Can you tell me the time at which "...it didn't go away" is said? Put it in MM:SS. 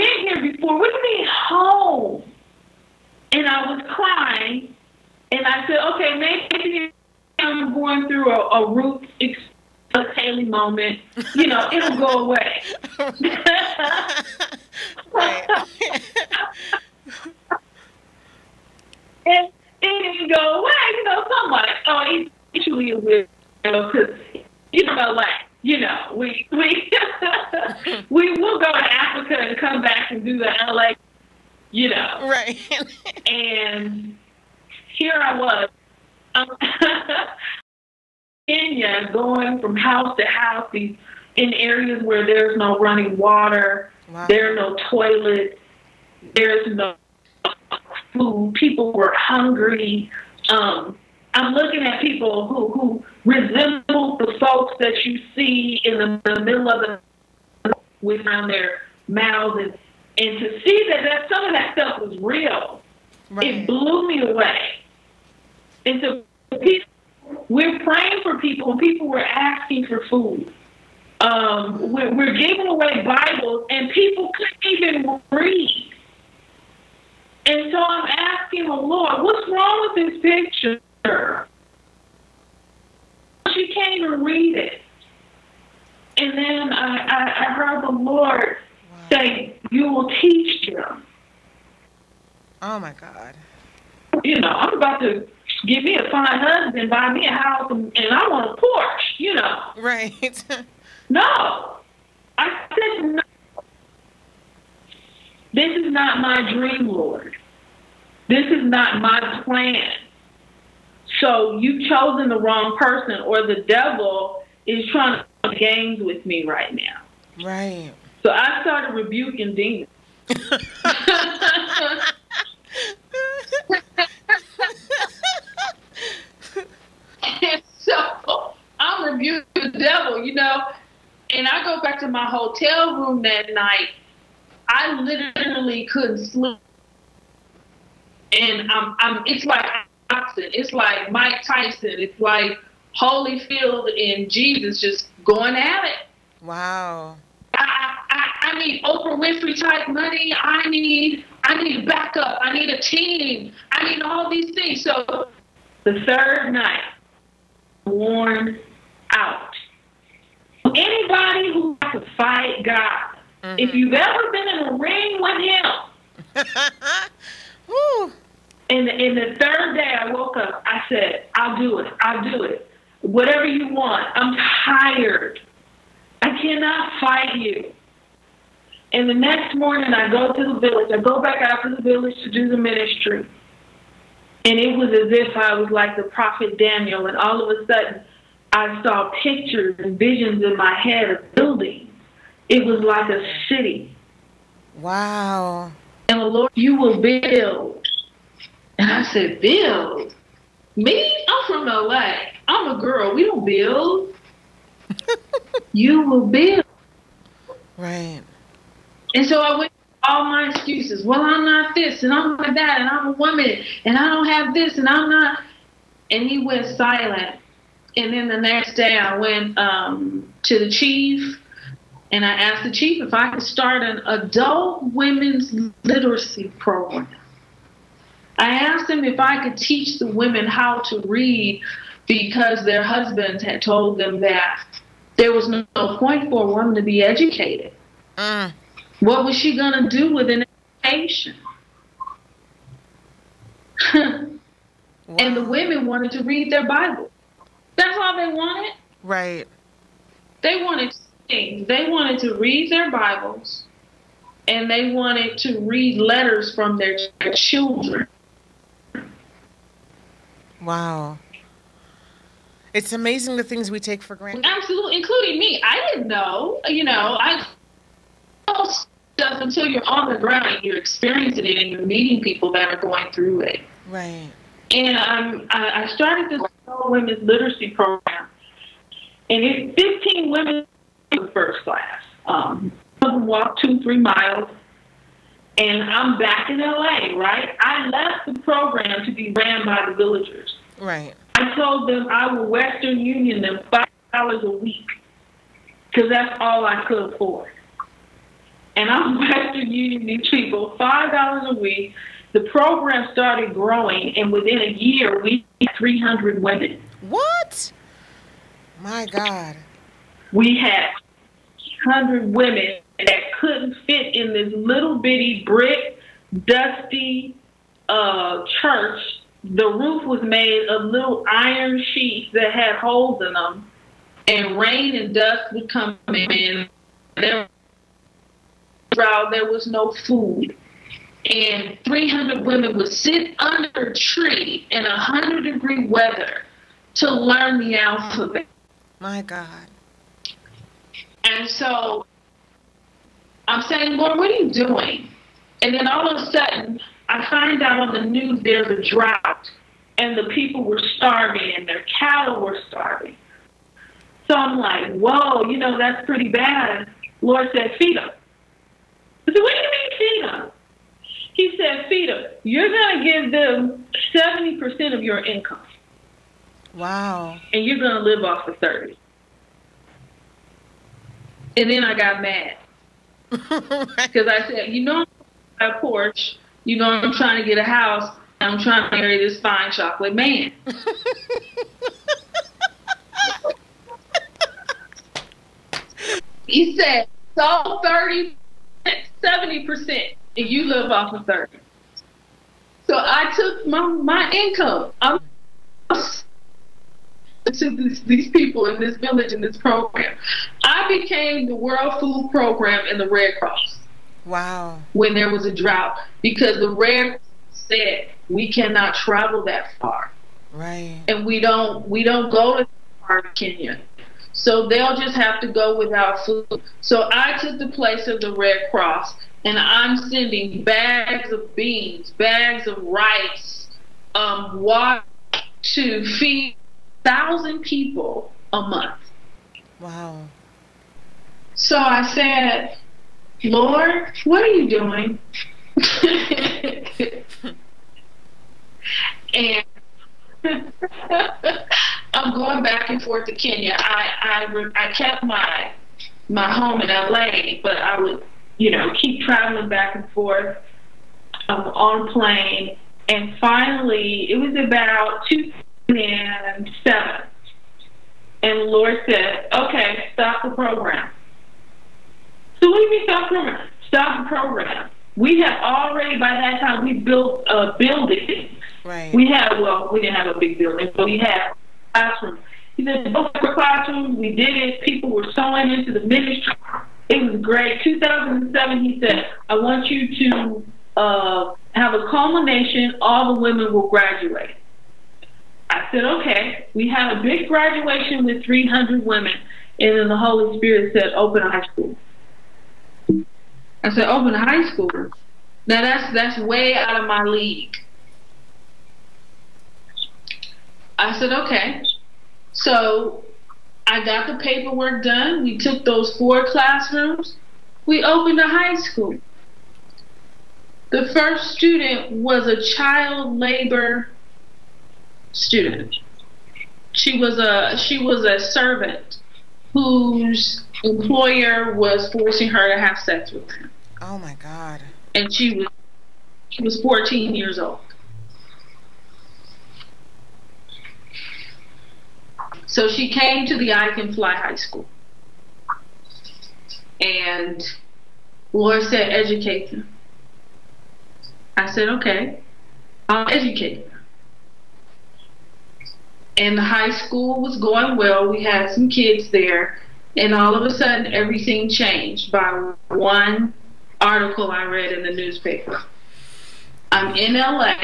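00:19.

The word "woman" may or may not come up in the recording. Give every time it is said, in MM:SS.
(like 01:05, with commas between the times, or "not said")
03:33, 03:56.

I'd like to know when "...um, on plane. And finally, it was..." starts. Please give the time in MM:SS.
07:31.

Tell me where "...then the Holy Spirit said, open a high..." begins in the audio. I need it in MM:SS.
08:09.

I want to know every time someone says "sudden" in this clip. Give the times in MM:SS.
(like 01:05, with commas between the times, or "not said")
03:07, 05:46, 09:10.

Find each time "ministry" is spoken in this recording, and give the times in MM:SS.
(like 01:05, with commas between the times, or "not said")
03:02, 07:56.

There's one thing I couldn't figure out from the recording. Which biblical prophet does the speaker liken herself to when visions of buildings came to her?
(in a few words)
Daniel.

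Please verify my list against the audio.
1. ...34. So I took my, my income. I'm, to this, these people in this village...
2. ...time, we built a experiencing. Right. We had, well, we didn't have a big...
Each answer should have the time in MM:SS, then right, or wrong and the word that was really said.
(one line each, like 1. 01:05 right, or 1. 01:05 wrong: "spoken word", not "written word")
1. 06:31 wrong: "30", not "34"
2. 07:46 wrong: "building", not "experiencing".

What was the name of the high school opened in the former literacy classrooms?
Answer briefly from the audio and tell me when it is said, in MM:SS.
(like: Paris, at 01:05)
I Can Fly High School, at 08:53.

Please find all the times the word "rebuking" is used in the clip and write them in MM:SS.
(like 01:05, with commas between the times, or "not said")
01:58, 02:09.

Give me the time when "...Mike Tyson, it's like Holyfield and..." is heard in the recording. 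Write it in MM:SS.
02:21.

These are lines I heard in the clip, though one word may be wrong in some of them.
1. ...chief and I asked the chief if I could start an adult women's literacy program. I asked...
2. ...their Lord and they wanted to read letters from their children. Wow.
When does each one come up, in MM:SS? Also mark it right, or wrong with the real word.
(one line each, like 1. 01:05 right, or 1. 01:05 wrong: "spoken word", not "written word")
1. 03:40 right
2. 04:12 wrong: "Bibles", not "Lord".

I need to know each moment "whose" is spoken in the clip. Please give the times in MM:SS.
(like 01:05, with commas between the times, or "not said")
08:39.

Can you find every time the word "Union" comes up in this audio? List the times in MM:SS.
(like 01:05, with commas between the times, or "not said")
04:52, 04:59.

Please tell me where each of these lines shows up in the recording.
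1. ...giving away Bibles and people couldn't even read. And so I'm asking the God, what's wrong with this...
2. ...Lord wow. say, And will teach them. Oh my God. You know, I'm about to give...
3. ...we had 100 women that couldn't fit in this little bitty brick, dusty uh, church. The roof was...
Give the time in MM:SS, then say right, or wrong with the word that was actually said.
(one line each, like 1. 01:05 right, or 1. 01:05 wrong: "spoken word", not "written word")
1. 01:12 wrong: "Lord", not "God"
2. 01:27 wrong: "You", not "And"
3. 05:10 right.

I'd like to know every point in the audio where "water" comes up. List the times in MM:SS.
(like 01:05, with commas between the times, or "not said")
00:43, 07:04.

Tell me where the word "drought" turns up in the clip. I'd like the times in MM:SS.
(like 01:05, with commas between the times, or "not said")
05:48, 06:45.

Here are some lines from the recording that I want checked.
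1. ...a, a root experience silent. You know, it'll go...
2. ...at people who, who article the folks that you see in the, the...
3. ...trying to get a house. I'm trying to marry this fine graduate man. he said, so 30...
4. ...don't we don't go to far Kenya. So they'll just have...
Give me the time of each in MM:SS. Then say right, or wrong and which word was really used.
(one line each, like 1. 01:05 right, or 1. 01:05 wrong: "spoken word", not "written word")
1. 00:08 wrong: "moment", not "silent"
2. 00:51 wrong: "resemble", not "article"
3. 06:17 wrong: "chocolate", not "graduate"
4. 06:51 right.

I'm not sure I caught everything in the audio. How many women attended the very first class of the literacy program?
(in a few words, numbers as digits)
15.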